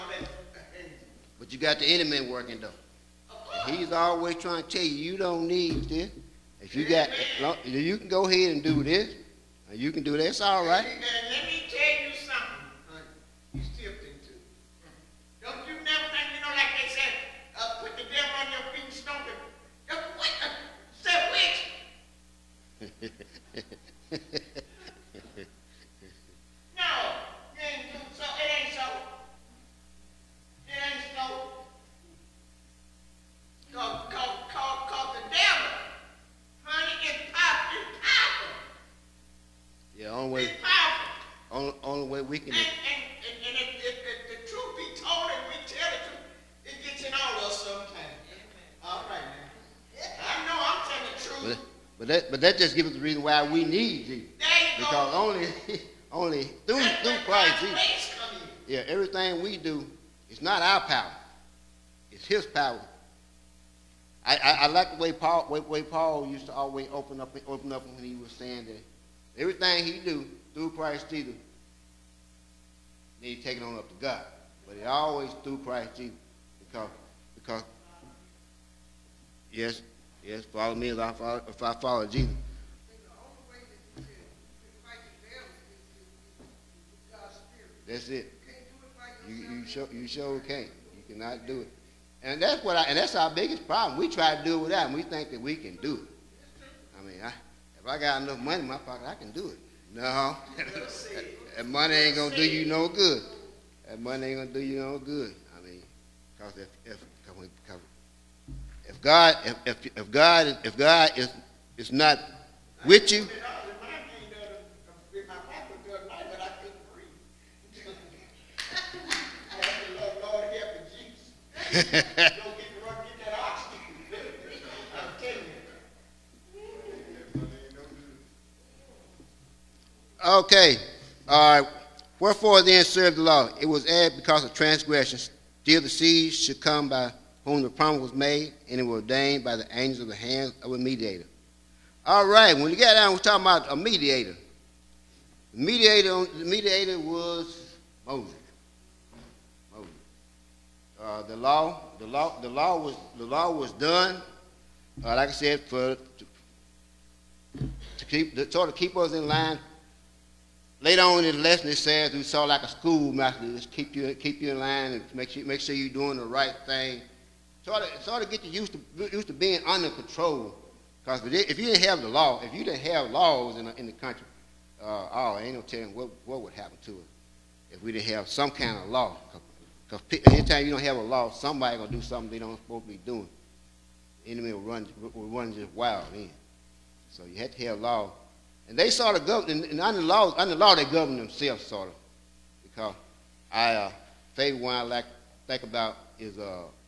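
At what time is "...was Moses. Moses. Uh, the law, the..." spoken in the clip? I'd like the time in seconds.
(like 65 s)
146 s.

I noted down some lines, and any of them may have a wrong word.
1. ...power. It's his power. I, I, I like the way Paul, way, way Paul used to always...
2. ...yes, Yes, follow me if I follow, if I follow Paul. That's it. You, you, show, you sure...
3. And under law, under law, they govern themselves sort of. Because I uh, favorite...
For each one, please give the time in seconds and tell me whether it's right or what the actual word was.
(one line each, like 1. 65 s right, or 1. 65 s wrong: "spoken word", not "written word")
1. 60 s right
2. 79 s wrong: "Jesus", not "Paul"
3. 189 s right.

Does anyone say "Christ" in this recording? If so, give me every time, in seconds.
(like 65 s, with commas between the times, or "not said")
57 s, 70 s, 75 s.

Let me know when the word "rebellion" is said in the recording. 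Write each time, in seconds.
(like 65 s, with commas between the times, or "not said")
not said.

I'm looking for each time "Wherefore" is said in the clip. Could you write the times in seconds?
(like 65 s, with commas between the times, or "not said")
132 s.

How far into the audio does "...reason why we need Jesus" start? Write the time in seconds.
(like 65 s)
53 s.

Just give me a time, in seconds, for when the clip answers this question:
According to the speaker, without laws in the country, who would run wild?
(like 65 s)
184 s.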